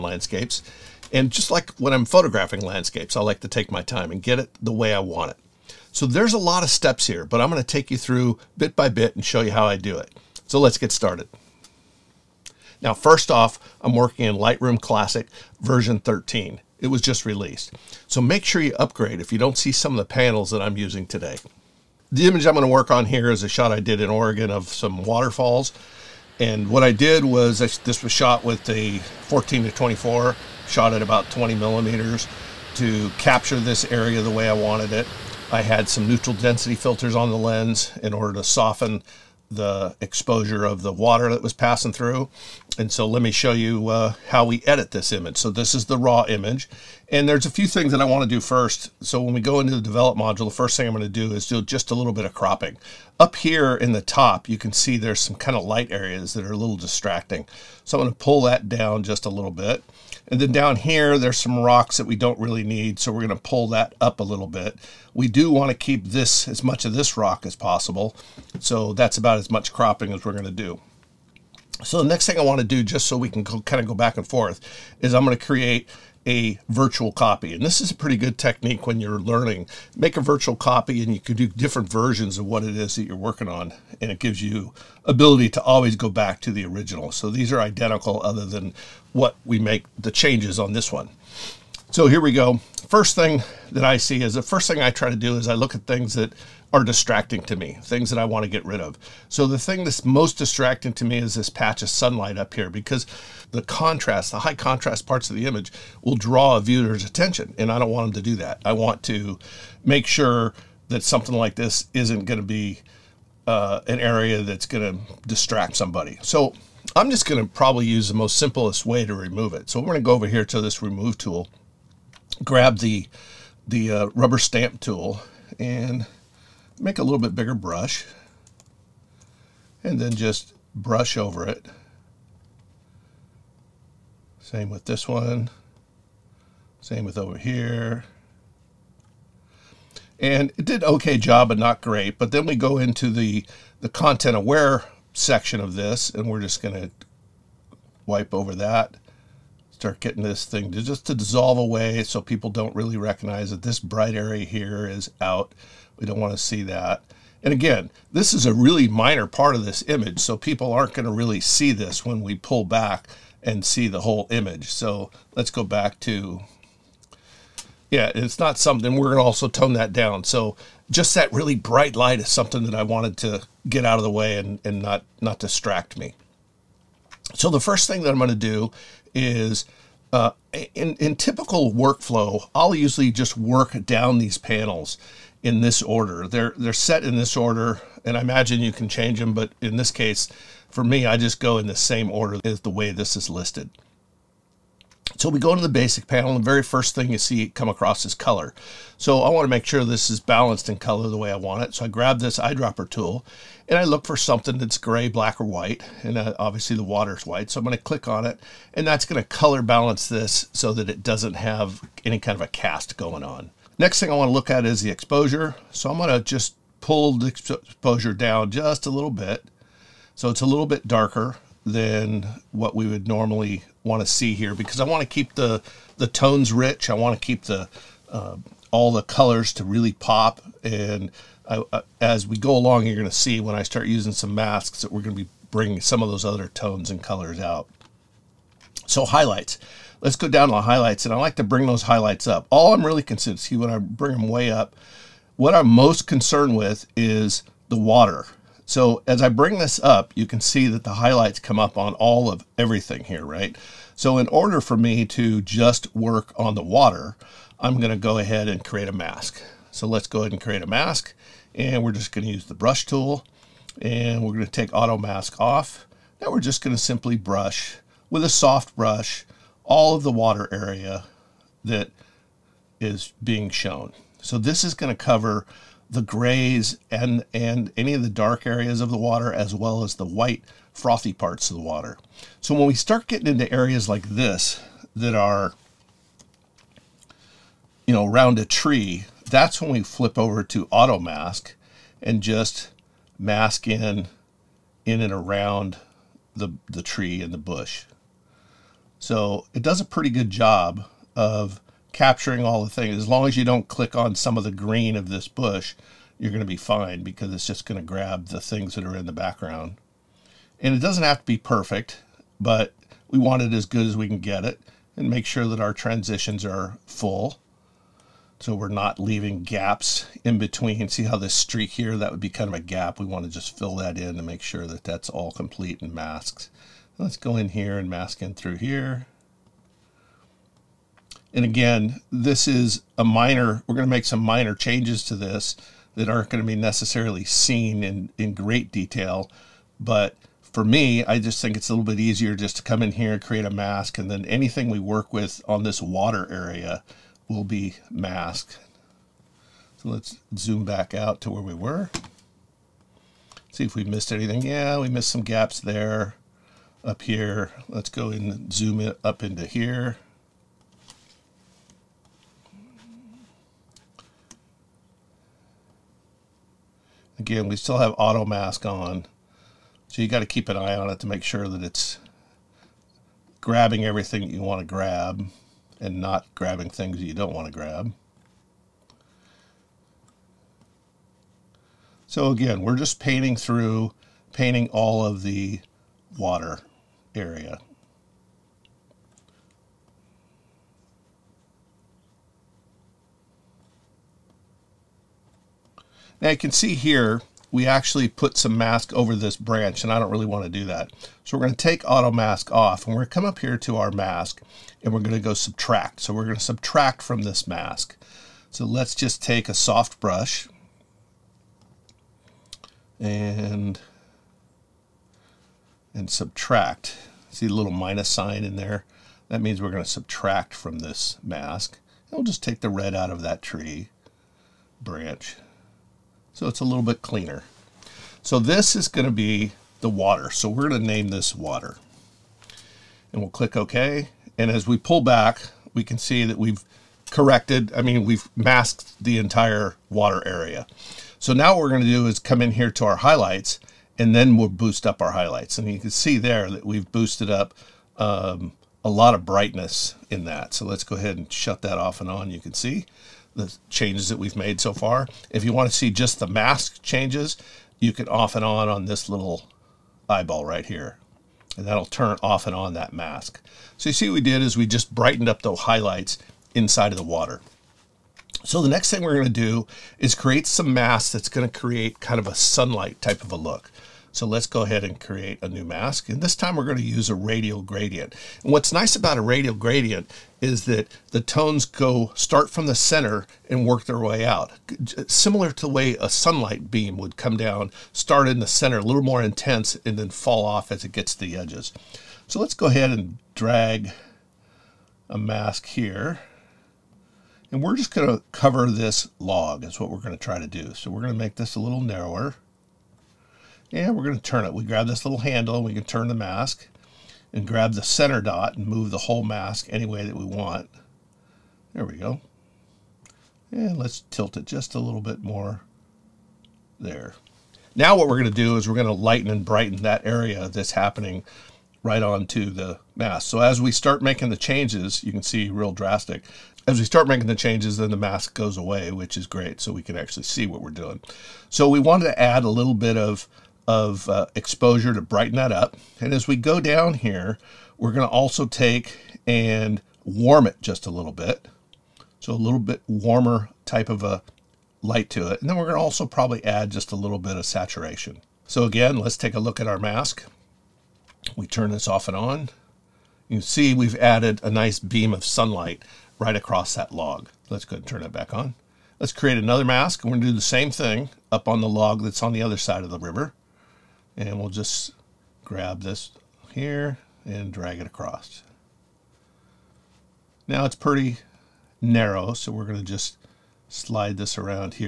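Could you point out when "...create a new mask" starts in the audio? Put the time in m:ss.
7:54.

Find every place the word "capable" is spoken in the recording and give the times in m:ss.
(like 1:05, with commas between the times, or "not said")
not said.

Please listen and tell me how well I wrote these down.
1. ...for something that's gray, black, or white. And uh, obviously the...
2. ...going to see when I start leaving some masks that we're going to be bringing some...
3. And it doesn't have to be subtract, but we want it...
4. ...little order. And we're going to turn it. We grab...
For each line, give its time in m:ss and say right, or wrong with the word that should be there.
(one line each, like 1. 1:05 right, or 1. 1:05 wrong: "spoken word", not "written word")
1. 3:24 right
2. 3:52 wrong: "using", not "leaving"
3. 5:10 wrong: "perfect", not "subtract"
4. 8:21 wrong: "narrower", not "order".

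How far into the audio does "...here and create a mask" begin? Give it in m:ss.
5:42.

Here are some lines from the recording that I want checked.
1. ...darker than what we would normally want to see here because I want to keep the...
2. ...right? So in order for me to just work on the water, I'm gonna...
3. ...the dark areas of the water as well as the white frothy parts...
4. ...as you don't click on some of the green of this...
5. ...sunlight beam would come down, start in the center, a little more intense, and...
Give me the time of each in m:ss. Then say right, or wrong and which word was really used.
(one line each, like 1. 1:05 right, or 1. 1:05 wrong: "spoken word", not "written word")
1. 3:40 right
2. 4:13 right
3. 4:38 right
4. 5:03 right
5. 8:06 right.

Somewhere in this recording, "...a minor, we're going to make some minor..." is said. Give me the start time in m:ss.
5:32.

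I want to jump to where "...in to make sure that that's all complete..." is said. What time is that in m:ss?
5:23.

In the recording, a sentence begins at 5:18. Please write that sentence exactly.
So we're not leaving gaps in between.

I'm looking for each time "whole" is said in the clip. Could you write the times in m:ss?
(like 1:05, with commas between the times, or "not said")
2:43, 8:28.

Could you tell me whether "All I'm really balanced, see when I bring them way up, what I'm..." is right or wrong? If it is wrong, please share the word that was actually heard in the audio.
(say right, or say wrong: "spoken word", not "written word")
wrong: "concerned", not "balanced".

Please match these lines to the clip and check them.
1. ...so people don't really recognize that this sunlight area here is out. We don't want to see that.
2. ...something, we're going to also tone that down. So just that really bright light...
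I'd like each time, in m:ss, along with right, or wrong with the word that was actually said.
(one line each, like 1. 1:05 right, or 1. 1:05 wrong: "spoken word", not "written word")
1. 2:32 wrong: "bright", not "sunlight"
2. 2:48 right.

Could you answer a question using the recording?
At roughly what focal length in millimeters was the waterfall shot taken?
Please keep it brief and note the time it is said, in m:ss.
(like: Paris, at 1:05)
20, at 0:31.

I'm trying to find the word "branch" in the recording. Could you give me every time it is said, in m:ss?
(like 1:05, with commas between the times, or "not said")
6:39, 7:04.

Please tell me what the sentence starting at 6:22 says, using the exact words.
So again, we're just painting through, painting all of the water area.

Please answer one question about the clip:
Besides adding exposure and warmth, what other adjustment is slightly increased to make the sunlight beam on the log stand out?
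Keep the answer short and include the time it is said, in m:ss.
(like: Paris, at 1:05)
Saturation, at 9:07.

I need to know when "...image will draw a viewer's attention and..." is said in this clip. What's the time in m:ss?
1:45.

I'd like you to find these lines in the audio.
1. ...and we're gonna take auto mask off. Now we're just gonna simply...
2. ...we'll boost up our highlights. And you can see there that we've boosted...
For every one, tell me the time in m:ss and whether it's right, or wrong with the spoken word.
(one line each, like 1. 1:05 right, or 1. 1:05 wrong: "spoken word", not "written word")
1. 4:23 right
2. 7:24 right.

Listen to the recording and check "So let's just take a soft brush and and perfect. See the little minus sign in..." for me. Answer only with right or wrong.
wrong.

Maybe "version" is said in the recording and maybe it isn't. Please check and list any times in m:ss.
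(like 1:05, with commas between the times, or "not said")
0:15, 1:21.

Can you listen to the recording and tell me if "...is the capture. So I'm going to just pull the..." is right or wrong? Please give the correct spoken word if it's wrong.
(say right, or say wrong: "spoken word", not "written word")
wrong: "exposure", not "capture".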